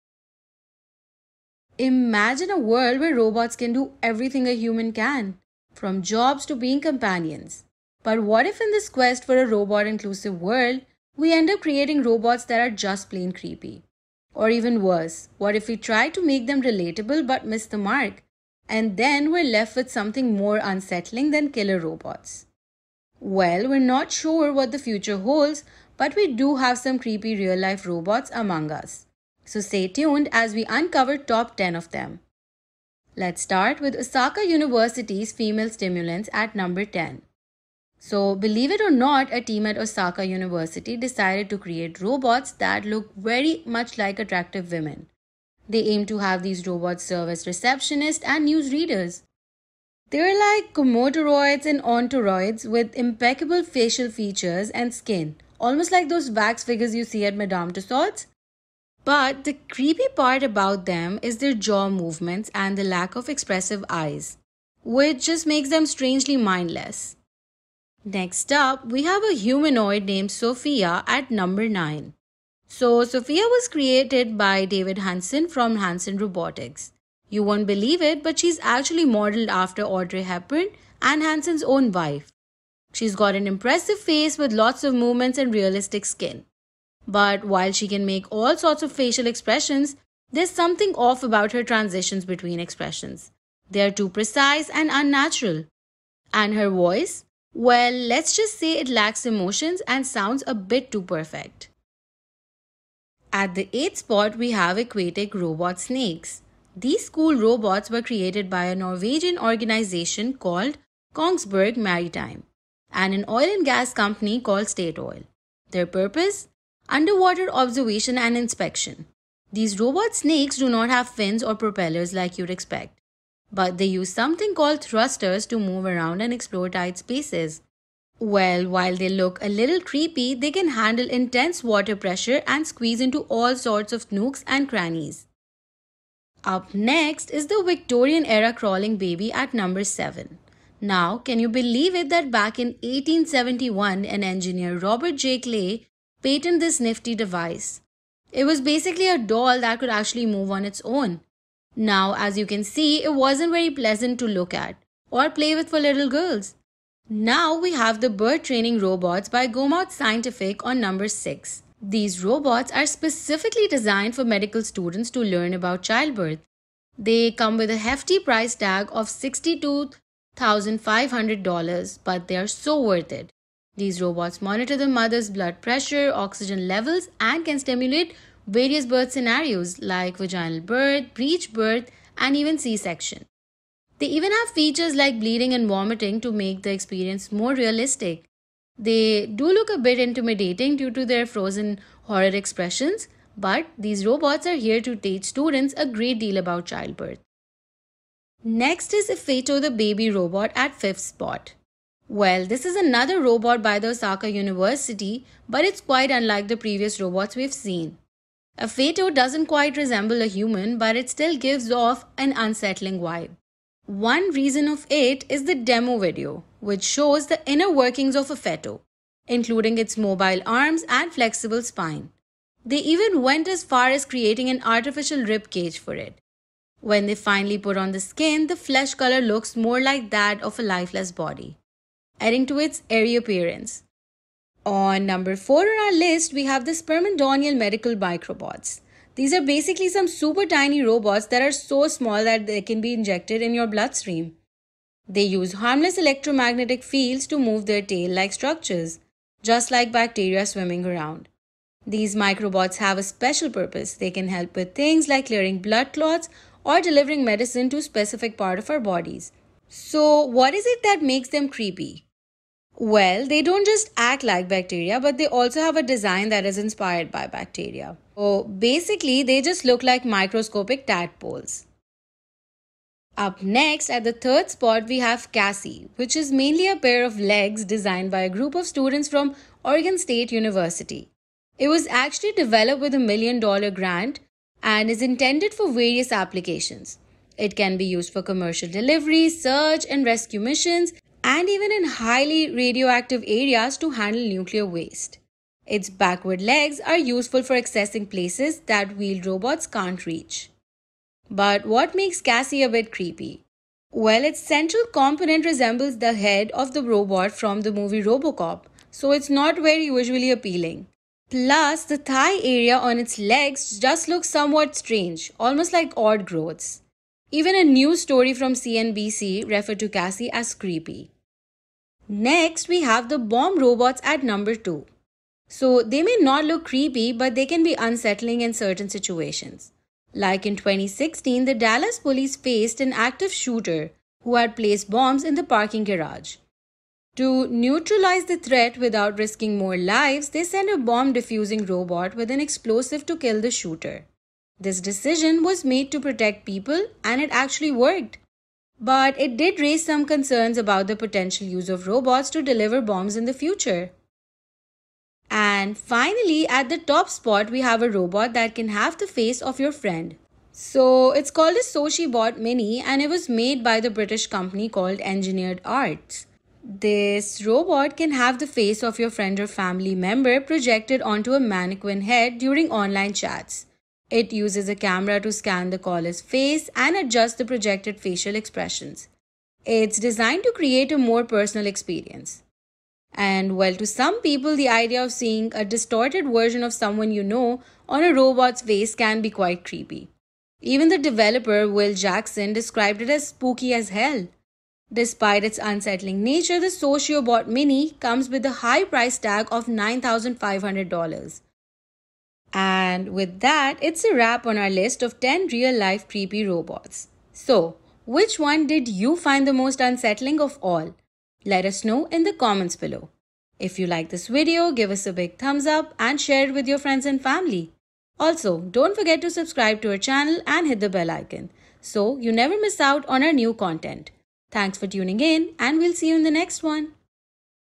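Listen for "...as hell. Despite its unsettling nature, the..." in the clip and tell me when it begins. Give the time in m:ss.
6:33.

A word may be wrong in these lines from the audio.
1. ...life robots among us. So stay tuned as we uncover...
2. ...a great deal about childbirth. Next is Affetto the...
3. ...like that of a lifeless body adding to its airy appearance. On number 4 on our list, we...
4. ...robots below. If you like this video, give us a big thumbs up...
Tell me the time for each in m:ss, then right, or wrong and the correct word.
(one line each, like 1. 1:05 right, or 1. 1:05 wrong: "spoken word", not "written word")
1. 0:27 right
2. 3:15 right
3. 3:49 right
4. 6:52 wrong: "comments", not "robots".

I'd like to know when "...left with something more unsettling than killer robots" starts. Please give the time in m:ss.
0:19.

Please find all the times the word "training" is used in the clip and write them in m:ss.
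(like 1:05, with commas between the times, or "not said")
2:38.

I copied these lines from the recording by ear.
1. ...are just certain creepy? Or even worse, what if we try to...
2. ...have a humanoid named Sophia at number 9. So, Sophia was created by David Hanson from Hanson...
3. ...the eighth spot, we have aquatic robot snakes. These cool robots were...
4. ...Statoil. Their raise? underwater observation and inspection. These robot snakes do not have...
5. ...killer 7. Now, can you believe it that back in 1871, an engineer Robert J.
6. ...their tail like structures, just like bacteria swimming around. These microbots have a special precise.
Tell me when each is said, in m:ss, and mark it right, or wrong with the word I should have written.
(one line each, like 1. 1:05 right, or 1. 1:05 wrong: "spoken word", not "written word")
1. 0:12 wrong: "plain", not "certain"
2. 1:09 right
3. 1:43 right
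4. 1:54 wrong: "purpose", not "raise"
5. 2:19 wrong: "number", not "killer"
6. 4:07 wrong: "purpose", not "precise".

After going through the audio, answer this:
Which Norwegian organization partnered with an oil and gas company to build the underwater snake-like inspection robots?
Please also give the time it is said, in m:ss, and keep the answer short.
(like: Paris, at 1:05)
Kongsberg Maritime, at 1:51.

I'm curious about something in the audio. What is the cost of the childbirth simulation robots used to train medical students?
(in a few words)
$62,500.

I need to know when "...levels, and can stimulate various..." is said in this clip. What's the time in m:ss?
2:56.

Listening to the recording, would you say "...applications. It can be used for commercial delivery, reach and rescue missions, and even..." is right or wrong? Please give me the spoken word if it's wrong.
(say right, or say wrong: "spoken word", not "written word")
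wrong: "search", not "reach".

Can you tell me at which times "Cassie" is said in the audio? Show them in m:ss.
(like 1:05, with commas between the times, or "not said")
4:35, 5:02, 5:19.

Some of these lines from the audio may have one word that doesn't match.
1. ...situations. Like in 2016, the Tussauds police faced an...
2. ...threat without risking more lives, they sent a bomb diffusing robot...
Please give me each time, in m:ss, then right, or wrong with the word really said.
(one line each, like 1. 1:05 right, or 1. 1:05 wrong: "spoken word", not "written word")
1. 5:28 wrong: "Dallas", not "Tussauds"
2. 5:38 right.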